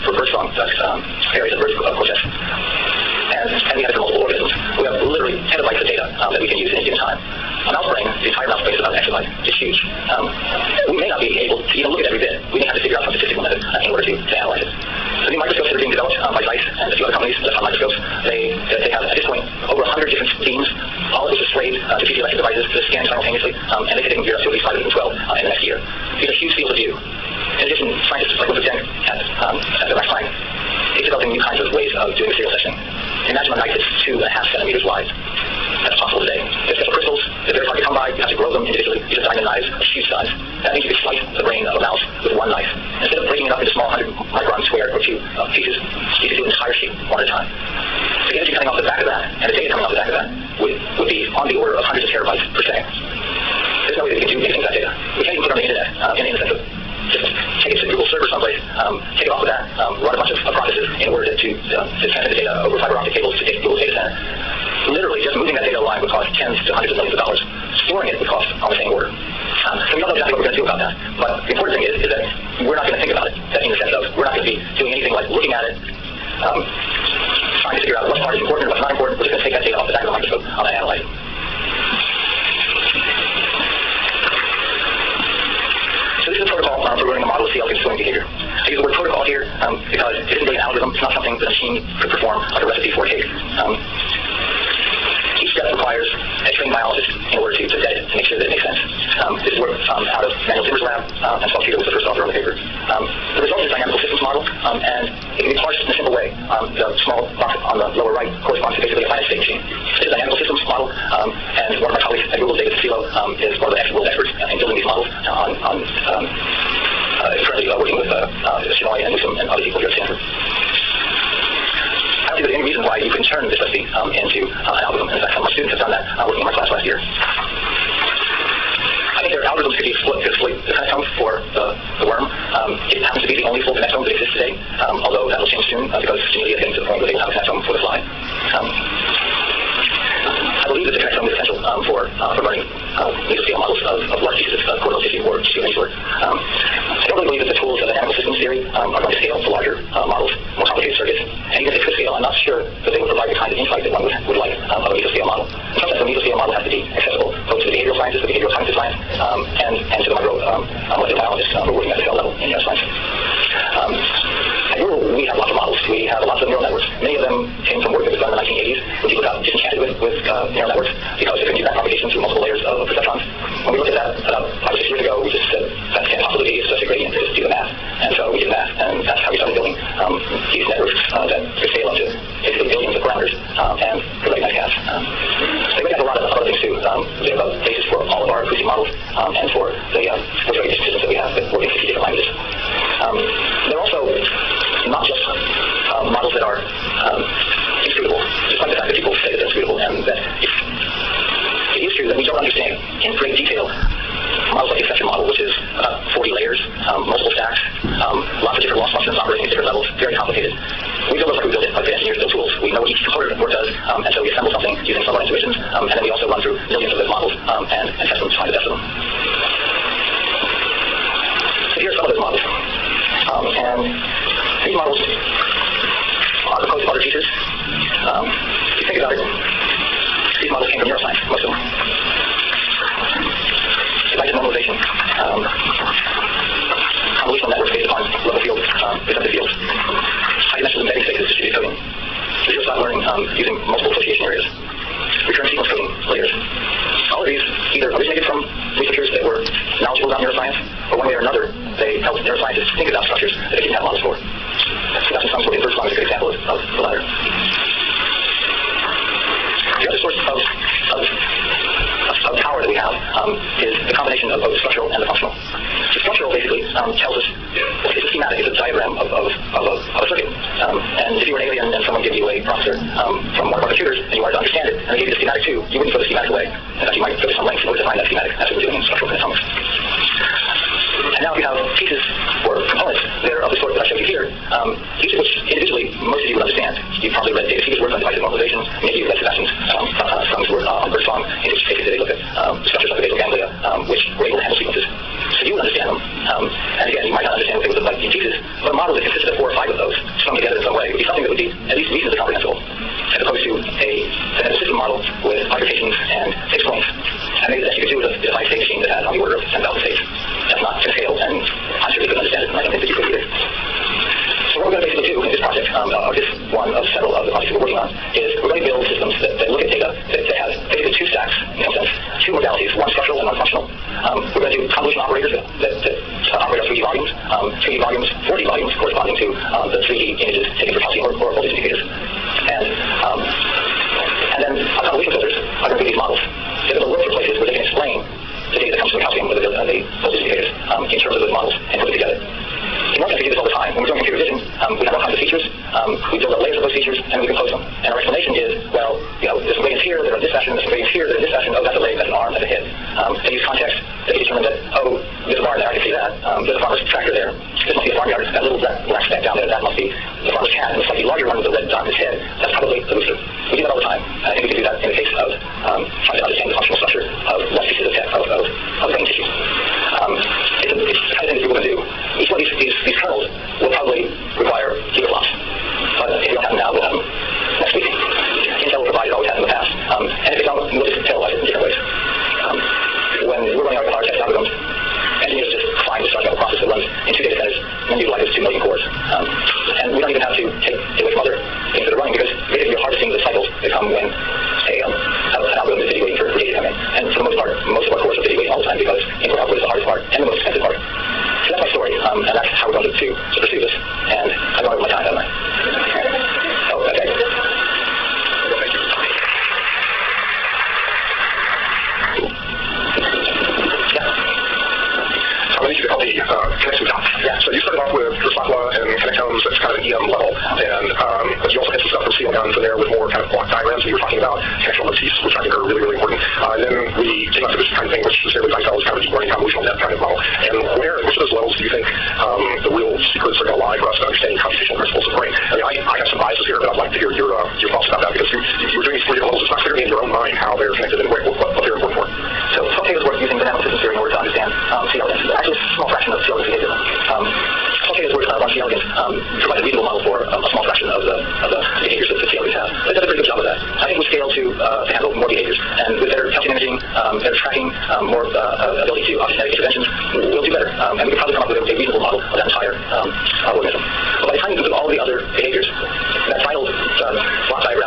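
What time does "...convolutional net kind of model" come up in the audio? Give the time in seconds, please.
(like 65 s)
429 s.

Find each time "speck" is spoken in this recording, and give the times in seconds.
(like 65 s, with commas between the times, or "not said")
359 s.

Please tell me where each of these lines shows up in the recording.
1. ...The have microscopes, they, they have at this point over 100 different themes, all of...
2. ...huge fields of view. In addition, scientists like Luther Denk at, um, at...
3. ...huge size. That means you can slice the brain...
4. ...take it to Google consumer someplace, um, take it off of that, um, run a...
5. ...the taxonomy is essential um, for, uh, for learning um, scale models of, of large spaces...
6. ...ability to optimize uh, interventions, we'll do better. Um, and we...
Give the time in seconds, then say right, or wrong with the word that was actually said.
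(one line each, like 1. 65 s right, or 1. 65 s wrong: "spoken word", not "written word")
1. 17 s right
2. 26 s right
3. 39 s right
4. 57 s wrong: "server", not "consumer"
5. 140 s wrong: "pieces", not "spaces"
6. 458 s right.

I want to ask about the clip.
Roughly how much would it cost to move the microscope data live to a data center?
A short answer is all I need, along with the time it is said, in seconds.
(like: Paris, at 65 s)
tens to hundreds of millions of dollars, at 66 s.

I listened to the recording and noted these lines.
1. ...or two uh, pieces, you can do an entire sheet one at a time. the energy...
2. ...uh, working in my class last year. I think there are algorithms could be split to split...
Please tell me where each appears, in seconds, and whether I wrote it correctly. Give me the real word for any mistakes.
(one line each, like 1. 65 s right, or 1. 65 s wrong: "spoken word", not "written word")
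1. 44 s right
2. 126 s right.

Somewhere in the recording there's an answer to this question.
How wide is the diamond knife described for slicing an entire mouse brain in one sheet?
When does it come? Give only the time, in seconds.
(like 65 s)
34 s.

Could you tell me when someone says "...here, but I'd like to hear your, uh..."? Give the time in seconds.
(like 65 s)
436 s.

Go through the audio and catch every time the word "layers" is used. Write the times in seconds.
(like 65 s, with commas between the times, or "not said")
172 s, 346 s.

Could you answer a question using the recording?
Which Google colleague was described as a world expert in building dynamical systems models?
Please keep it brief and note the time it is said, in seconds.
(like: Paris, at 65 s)
David Sussillo, at 112 s.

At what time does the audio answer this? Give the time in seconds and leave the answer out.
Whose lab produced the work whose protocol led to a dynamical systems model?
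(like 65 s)
100 s.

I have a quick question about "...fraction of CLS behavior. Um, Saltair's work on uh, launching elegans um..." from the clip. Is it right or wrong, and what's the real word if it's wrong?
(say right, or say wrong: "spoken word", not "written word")
right.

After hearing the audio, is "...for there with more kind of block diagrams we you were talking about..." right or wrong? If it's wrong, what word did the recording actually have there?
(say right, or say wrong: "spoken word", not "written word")
right.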